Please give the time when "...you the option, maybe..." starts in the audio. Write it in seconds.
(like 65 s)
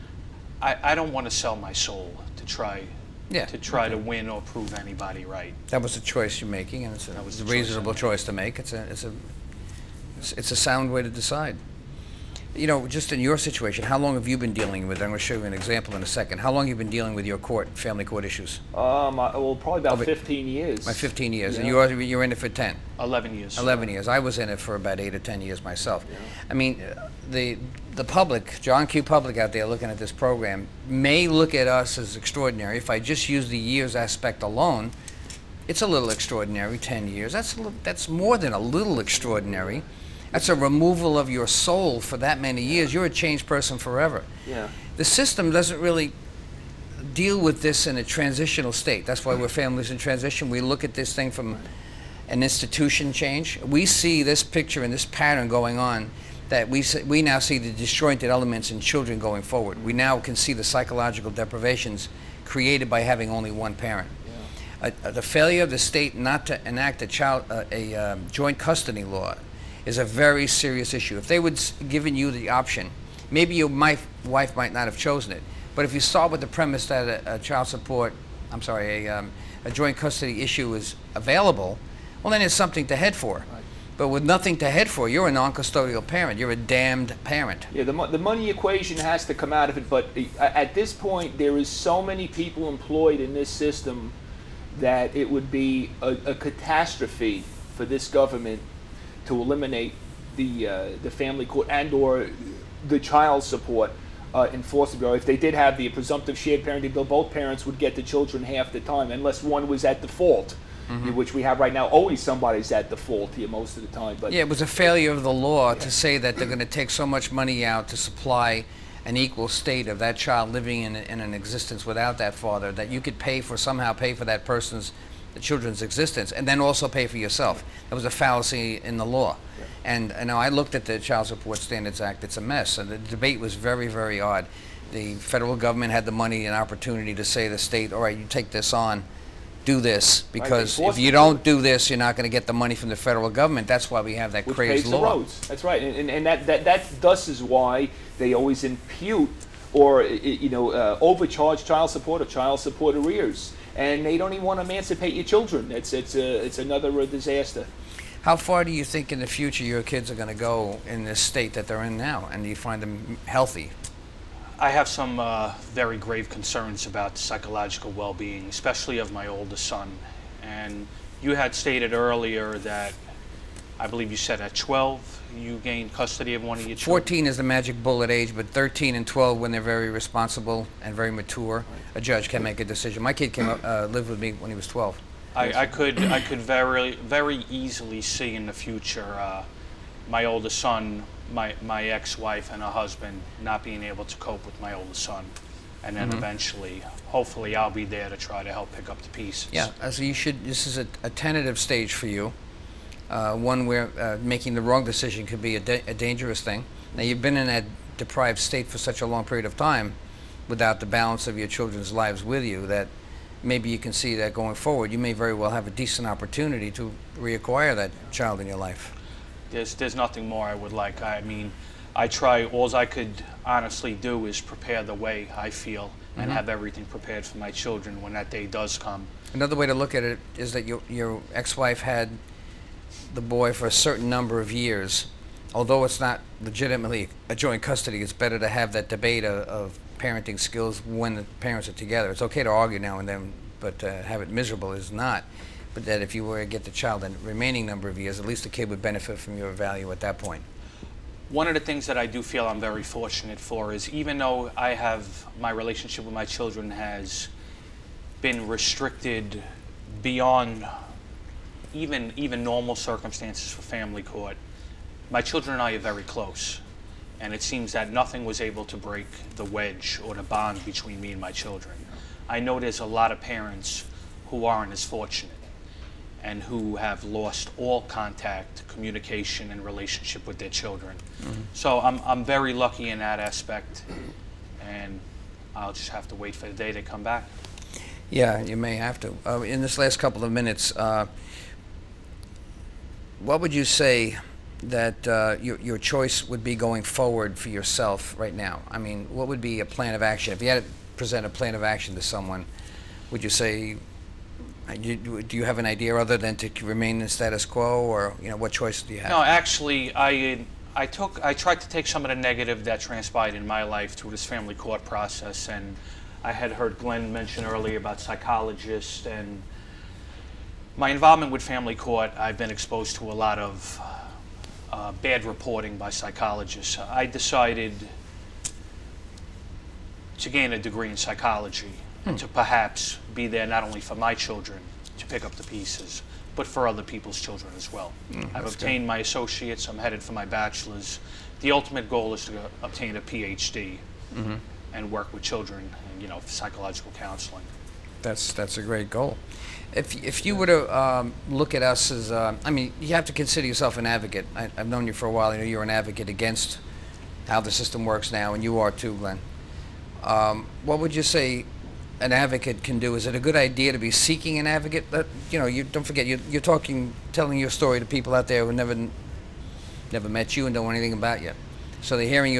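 72 s.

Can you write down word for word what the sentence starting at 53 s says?
We see this picture and this pattern going on that we, we now see the disjointed elements in children going forward.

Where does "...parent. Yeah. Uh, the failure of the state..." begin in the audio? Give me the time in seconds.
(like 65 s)
63 s.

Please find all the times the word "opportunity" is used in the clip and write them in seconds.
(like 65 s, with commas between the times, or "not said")
136 s, 216 s.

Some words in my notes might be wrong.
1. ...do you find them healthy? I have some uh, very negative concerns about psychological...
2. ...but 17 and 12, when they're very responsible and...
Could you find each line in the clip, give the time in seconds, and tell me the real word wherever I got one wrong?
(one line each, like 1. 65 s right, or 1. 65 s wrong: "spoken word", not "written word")
1. 162 s wrong: "grave", not "negative"
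2. 178 s wrong: "13", not "17".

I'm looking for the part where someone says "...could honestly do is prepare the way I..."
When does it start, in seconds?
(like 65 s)
222 s.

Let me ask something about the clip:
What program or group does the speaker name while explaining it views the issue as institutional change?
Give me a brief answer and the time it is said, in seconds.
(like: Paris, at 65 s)
Families in Transition, at 49 s.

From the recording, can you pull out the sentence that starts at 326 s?
I decided to gain a degree in psychology hmm.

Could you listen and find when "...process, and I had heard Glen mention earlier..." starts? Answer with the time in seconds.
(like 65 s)
314 s.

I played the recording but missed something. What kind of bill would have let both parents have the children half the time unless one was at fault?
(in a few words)
Presumptive shared parenting bill.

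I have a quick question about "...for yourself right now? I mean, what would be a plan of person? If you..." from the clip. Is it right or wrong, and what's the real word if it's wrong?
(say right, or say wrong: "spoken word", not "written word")
wrong: "action", not "person".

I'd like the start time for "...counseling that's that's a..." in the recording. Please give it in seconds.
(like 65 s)
347 s.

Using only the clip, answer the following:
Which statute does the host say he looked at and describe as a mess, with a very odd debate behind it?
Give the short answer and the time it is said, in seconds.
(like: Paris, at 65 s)
Child Support Standards Act, at 130 s.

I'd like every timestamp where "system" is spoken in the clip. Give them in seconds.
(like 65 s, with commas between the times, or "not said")
45 s, 93 s, 357 s.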